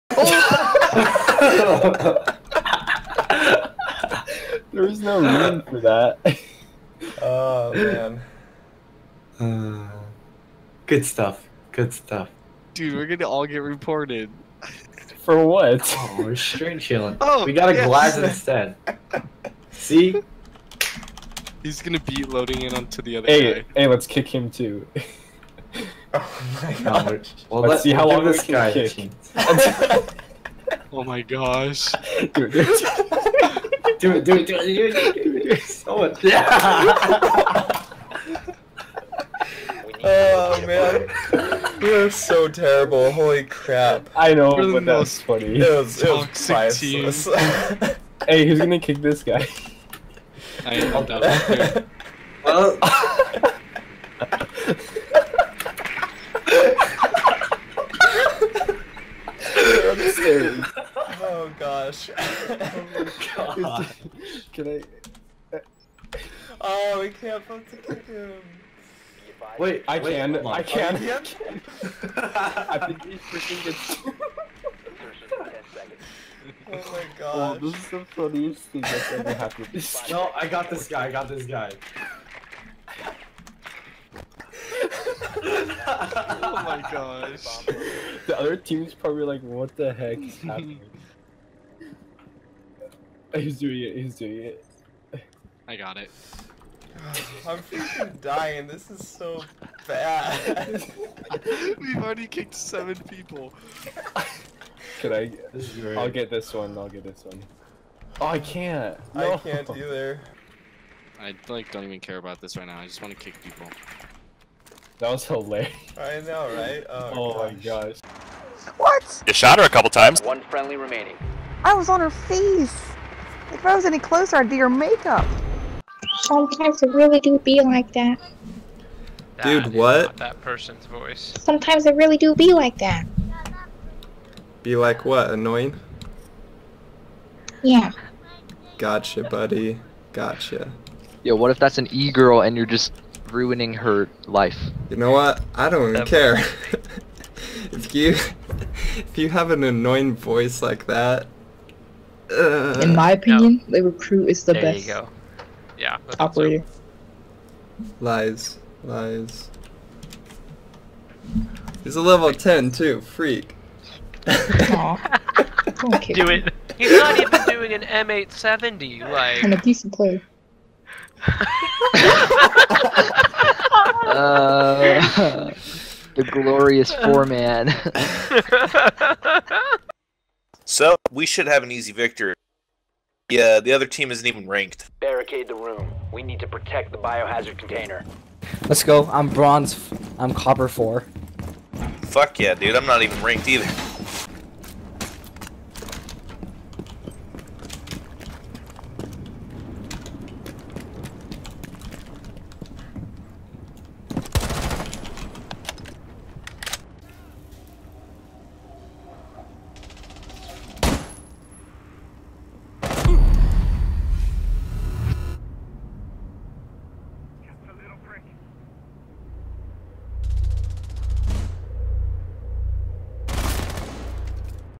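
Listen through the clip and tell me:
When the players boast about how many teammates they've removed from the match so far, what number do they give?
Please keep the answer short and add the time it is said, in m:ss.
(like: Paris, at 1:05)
7, at 1:42.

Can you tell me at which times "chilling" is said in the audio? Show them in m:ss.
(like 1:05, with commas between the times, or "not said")
0:16.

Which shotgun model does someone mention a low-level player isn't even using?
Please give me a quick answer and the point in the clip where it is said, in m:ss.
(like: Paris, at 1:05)
M870, at 2:47.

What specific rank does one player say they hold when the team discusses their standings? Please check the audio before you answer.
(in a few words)
Copper 4.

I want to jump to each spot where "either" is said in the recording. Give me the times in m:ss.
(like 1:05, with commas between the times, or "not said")
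1:49, 3:13.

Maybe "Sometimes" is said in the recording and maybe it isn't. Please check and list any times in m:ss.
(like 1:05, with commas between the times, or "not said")
2:06, 2:11.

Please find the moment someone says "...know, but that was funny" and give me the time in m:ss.
0:44.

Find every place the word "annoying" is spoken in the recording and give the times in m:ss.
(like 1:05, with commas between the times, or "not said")
2:15, 2:29.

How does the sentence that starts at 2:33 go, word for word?
the recruit is the there best.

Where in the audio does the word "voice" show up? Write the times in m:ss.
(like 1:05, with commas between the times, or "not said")
2:10, 2:30.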